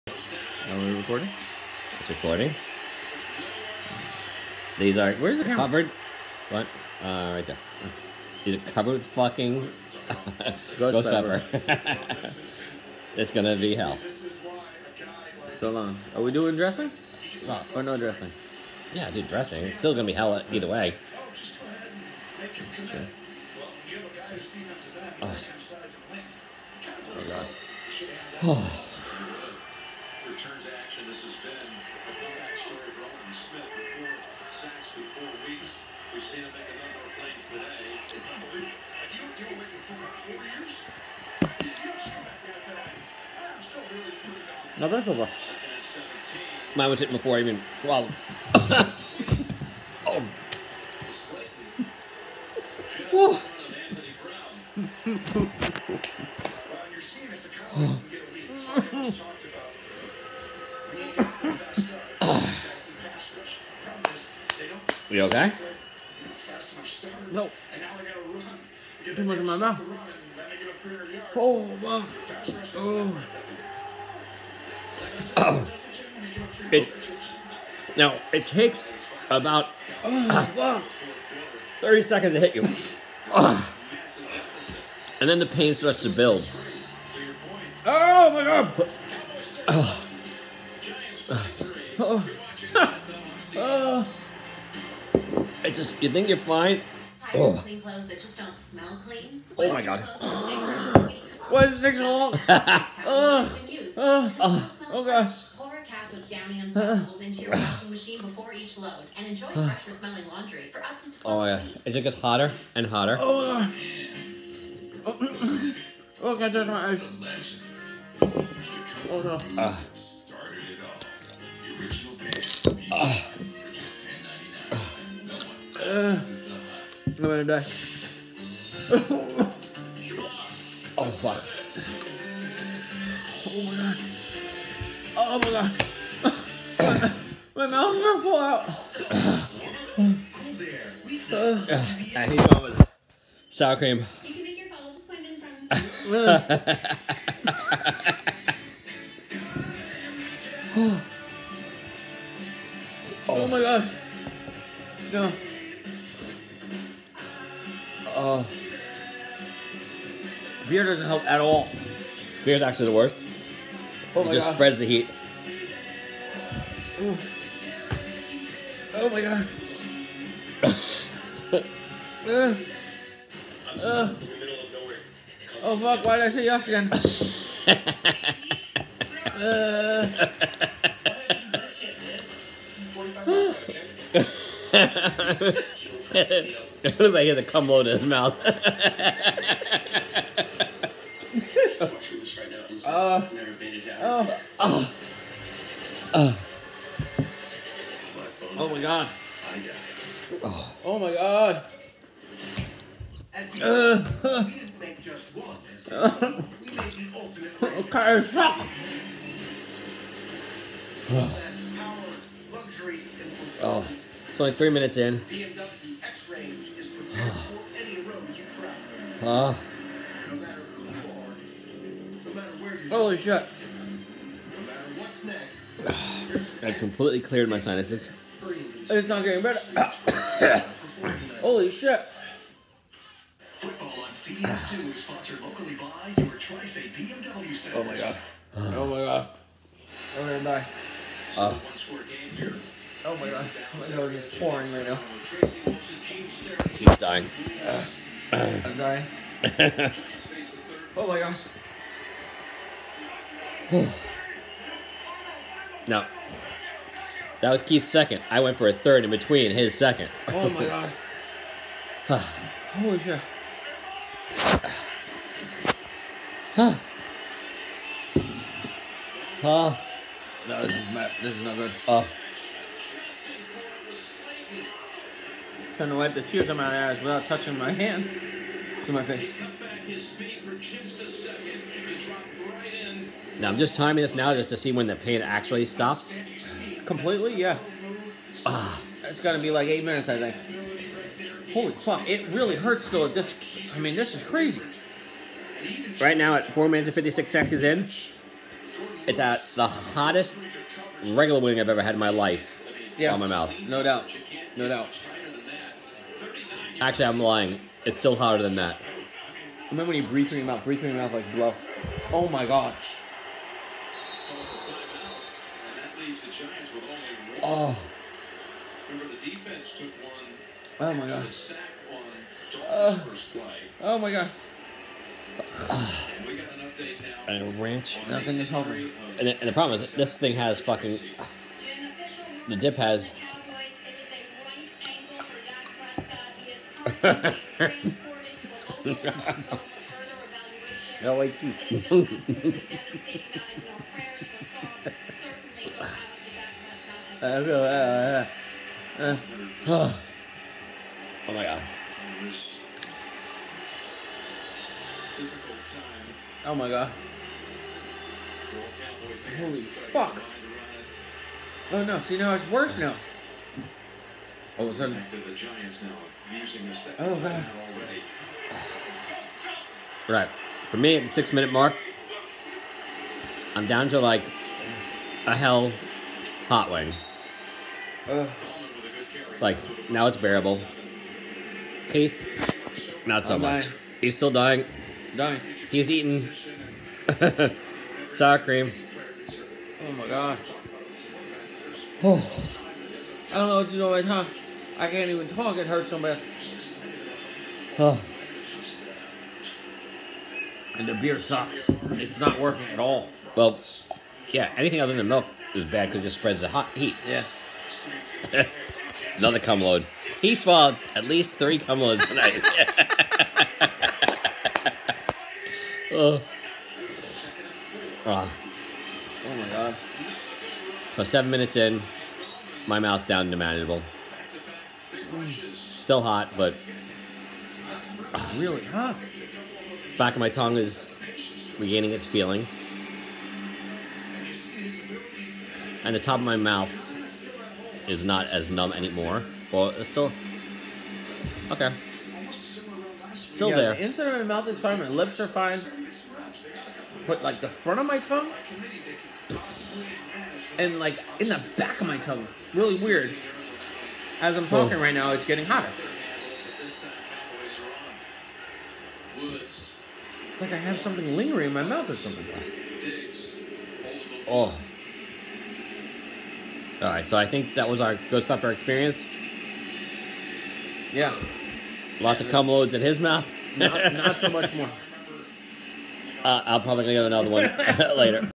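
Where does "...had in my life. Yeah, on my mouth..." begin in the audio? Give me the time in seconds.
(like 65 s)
301 s.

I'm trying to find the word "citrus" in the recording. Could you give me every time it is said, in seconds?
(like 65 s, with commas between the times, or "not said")
not said.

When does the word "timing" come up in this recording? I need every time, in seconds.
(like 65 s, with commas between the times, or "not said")
283 s.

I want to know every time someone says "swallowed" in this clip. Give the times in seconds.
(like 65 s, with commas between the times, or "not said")
47 s, 410 s.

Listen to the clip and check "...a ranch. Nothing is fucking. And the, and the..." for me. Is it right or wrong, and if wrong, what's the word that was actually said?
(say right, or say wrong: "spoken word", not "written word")
wrong: "helping", not "fucking".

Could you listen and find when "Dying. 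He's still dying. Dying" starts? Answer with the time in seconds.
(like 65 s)
383 s.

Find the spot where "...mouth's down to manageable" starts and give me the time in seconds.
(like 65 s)
422 s.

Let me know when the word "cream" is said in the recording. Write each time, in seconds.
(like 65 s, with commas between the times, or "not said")
143 s, 388 s.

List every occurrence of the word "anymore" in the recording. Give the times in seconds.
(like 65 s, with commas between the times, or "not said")
438 s.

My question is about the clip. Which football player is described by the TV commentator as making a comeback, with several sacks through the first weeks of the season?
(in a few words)
Aldon Smith.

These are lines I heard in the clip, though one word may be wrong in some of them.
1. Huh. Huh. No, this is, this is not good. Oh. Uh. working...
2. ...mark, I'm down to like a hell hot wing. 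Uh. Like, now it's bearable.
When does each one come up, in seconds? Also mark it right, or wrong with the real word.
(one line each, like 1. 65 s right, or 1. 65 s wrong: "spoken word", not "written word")
1. 266 s wrong: "trying", not "working"
2. 371 s right.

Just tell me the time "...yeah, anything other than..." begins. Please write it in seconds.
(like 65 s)
404 s.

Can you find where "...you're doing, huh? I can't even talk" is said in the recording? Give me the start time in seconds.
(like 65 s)
393 s.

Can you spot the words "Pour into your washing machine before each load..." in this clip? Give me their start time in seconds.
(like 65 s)
105 s.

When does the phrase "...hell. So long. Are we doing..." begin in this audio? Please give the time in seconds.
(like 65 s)
13 s.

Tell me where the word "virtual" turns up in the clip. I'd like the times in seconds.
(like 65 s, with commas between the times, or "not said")
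not said.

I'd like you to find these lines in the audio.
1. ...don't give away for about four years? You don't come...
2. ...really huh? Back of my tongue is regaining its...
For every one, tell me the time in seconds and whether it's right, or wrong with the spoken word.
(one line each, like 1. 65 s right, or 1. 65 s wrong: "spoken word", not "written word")
1. 39 s right
2. 428 s right.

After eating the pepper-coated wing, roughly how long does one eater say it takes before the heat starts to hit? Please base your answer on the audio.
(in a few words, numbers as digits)
30 seconds.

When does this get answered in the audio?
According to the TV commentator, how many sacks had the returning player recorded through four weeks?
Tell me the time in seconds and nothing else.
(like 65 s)
33 s.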